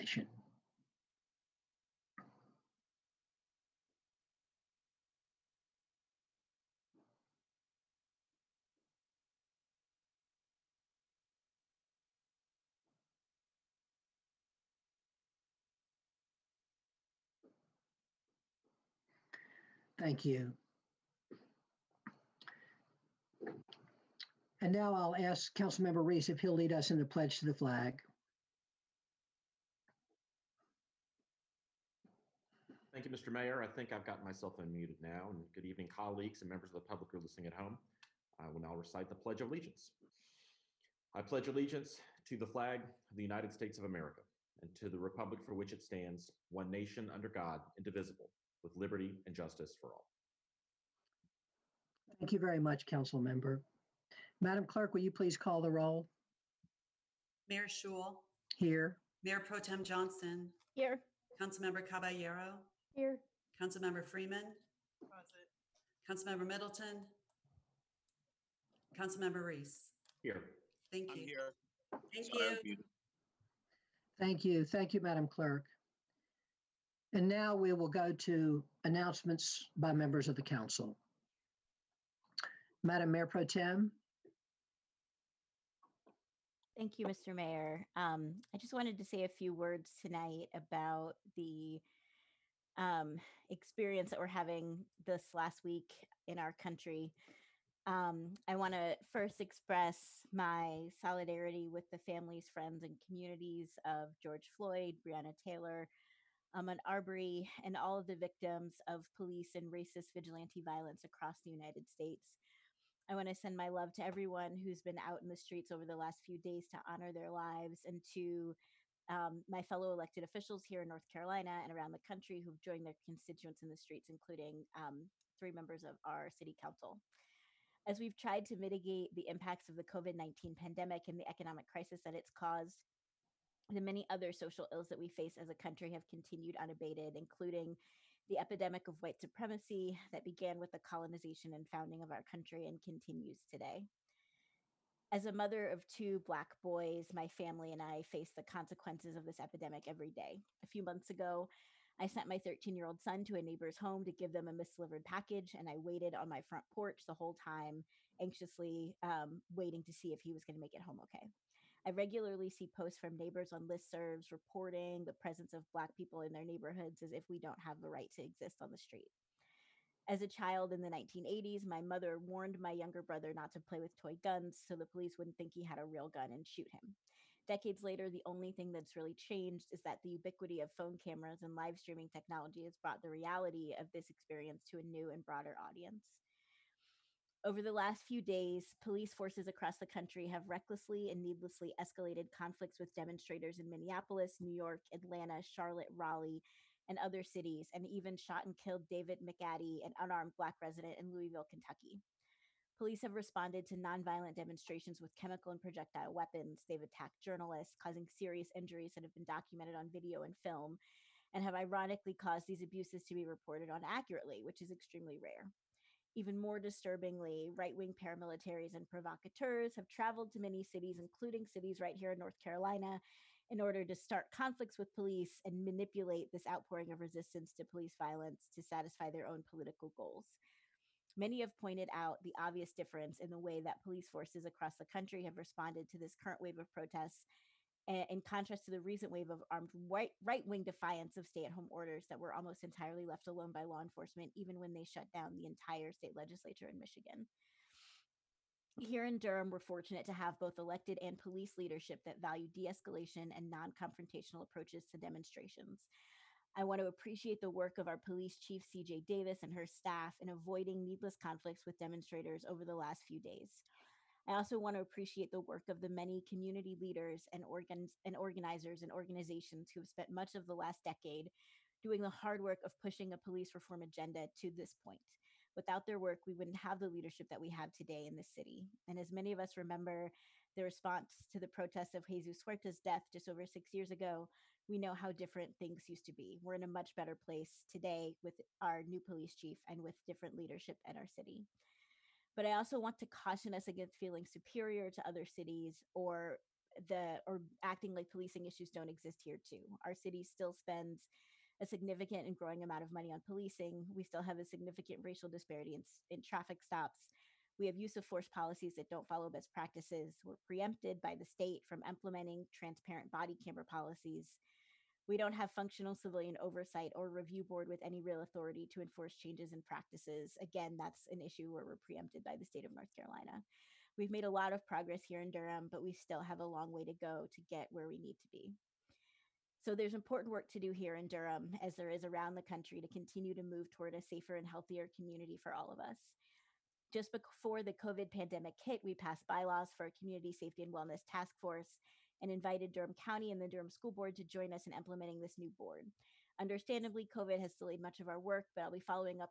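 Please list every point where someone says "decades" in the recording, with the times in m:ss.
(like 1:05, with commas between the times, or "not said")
2:57, 4:30.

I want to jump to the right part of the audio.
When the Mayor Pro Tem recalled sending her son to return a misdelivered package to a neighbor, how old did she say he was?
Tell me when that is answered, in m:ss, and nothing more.
2:32.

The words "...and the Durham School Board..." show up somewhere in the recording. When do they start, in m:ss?
5:43.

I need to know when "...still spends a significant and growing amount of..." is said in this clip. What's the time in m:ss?
5:00.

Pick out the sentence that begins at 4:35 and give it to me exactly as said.
Without their work, we wouldn't have the leadership that we have today in the city.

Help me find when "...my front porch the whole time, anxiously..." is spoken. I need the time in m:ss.
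2:36.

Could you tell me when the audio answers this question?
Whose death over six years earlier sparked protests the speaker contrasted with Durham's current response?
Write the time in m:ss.
4:42.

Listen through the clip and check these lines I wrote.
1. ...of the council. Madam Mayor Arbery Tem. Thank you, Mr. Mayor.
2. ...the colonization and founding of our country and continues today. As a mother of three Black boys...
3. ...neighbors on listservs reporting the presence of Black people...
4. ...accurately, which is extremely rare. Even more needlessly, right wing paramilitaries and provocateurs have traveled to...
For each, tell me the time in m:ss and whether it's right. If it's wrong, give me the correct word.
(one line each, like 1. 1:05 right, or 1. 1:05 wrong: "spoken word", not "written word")
1. 1:20 wrong: "Pro", not "Arbery"
2. 2:20 wrong: "two", not "three"
3. 2:43 right
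4. 3:33 wrong: "disturbingly", not "needlessly".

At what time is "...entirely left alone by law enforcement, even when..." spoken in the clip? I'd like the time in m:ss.
4:02.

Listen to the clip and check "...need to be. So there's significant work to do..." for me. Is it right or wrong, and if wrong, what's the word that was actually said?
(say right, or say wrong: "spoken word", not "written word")
wrong: "important", not "significant".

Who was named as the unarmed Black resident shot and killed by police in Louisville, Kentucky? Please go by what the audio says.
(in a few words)
David McAtee.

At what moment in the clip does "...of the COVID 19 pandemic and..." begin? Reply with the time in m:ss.
2:09.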